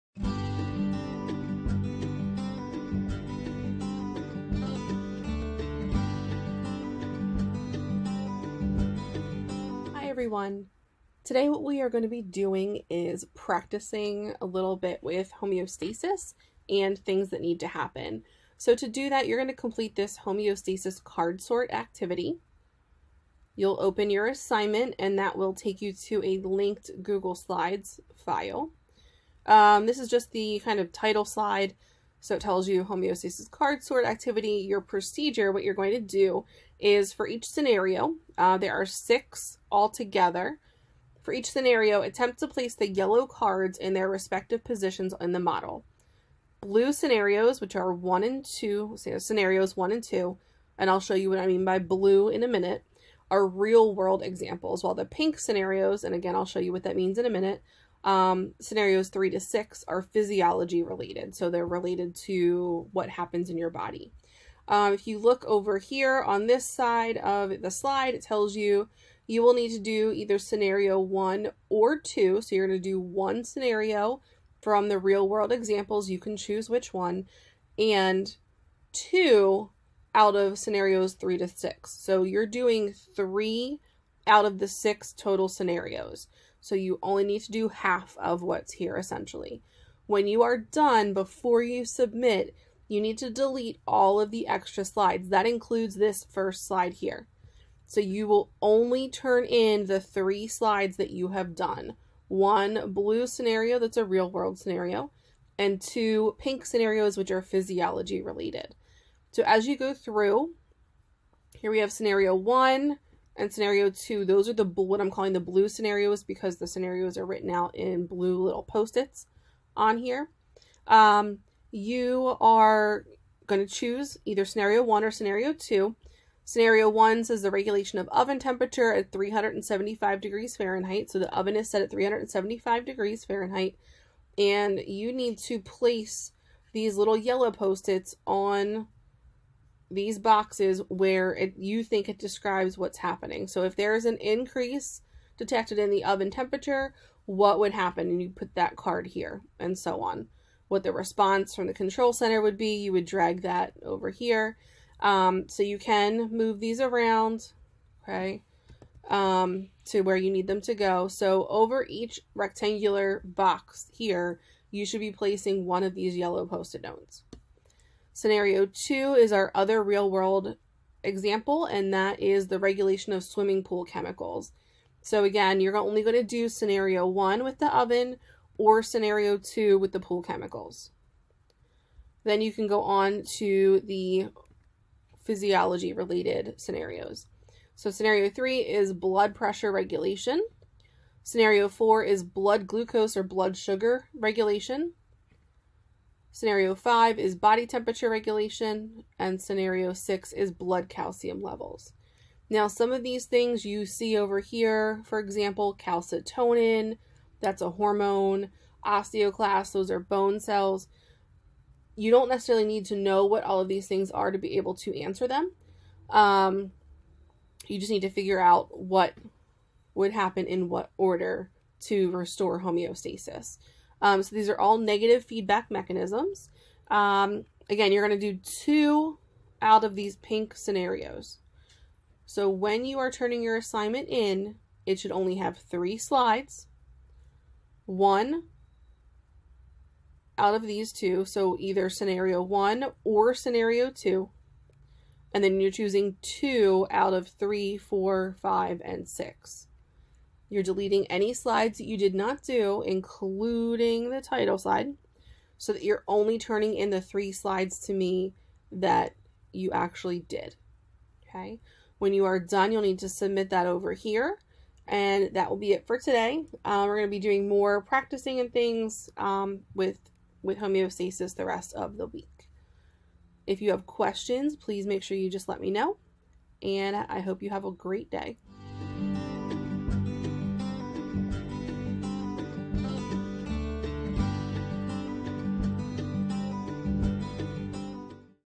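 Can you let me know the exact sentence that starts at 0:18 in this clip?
So to do that, you're going to complete this homeostasis card sort activity.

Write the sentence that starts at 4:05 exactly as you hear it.
And then you're choosing two out of three, four, five, and six.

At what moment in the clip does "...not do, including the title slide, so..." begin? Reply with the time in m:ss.
4:12.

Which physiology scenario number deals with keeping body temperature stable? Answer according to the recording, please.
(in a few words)
5.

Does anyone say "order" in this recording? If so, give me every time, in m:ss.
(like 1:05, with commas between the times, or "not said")
3:40.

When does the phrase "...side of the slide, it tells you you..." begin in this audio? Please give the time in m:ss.
1:06.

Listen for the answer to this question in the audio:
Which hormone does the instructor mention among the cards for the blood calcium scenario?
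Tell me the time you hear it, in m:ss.
3:25.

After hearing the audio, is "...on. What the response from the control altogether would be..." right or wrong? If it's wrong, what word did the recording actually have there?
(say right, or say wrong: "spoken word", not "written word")
wrong: "center", not "altogether".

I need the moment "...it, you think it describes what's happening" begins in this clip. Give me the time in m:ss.
2:21.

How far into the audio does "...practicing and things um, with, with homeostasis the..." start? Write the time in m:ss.
4:27.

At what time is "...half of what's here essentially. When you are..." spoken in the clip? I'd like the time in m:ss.
1:27.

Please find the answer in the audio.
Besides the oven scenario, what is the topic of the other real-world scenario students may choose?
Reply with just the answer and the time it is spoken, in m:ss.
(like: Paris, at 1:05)
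Swimming pool chemicals, at 2:53.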